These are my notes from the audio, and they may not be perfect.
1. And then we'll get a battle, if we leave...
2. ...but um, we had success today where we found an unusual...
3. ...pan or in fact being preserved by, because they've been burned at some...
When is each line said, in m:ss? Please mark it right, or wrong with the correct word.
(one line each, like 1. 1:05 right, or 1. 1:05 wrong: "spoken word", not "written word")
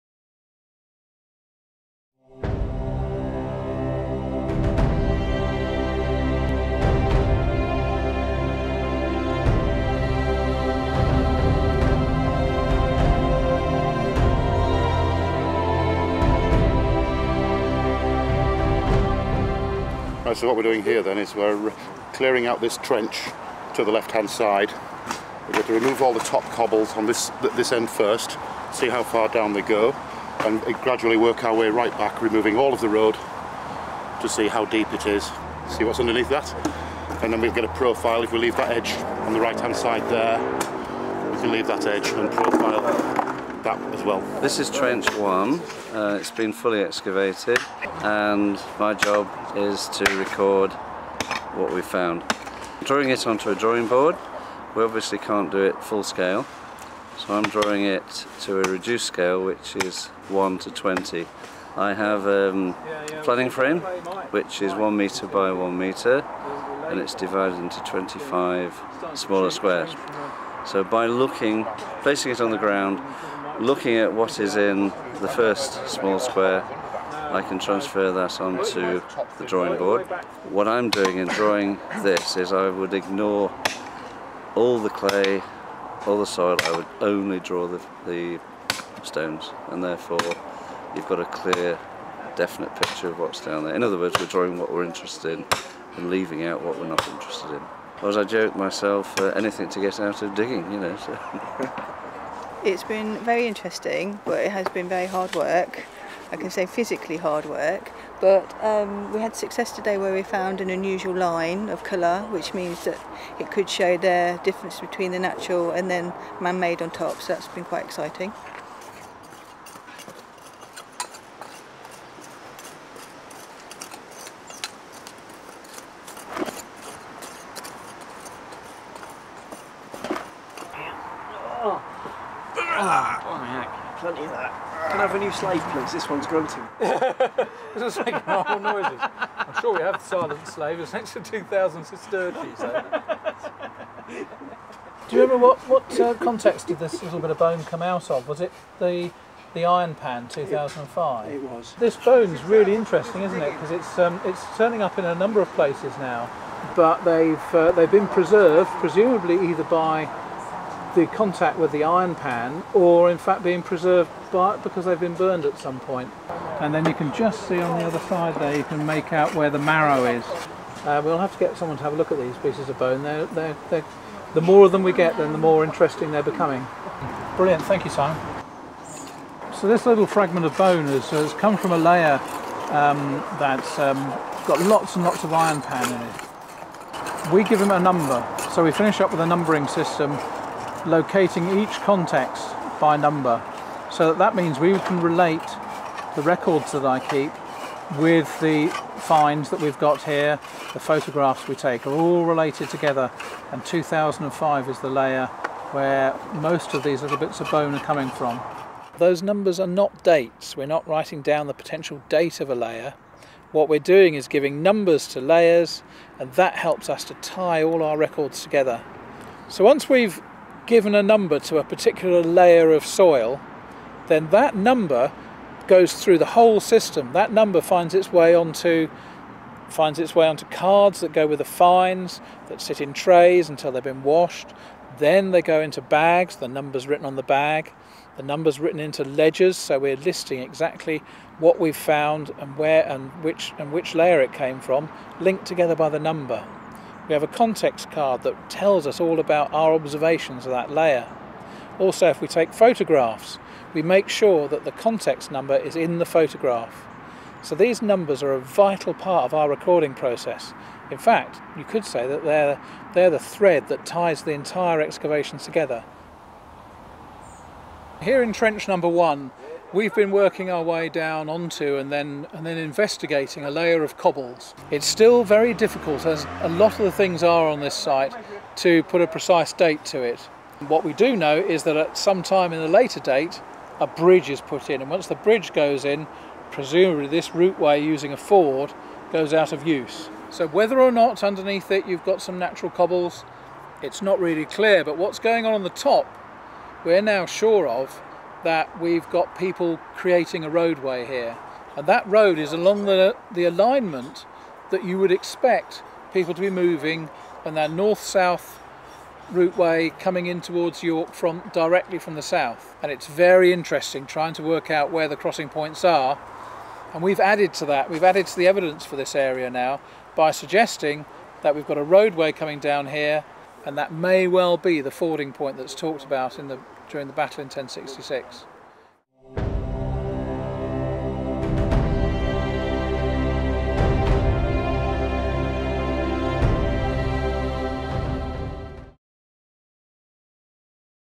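1. 0:37 wrong: "profile", not "battle"
2. 1:48 right
3. 2:42 right.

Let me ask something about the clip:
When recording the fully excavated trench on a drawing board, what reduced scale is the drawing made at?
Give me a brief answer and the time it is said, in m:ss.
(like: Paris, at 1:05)
1 to 20, at 1:00.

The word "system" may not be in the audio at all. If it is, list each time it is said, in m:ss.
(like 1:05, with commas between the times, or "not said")
3:09, 3:46.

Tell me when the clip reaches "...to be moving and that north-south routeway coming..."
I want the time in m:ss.
5:06.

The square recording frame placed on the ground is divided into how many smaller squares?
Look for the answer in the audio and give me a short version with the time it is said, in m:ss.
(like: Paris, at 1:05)
25, at 1:07.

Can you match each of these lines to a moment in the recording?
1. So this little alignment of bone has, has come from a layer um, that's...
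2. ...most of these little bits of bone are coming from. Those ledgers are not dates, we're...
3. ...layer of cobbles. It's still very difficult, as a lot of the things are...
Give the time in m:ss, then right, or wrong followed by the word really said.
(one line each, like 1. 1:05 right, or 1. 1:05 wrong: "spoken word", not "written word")
1. 2:59 wrong: "fragment", not "alignment"
2. 3:26 wrong: "numbers", not "ledgers"
3. 4:33 right.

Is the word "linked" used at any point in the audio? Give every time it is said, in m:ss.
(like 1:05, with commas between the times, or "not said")
4:05.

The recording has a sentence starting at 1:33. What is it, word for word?
In other words we're drawing what we're interested in and leaving out what we're not interested in.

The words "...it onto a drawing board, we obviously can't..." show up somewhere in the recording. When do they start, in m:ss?
0:53.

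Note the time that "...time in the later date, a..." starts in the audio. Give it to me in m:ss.
4:42.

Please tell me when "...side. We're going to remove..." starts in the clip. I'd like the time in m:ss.
0:24.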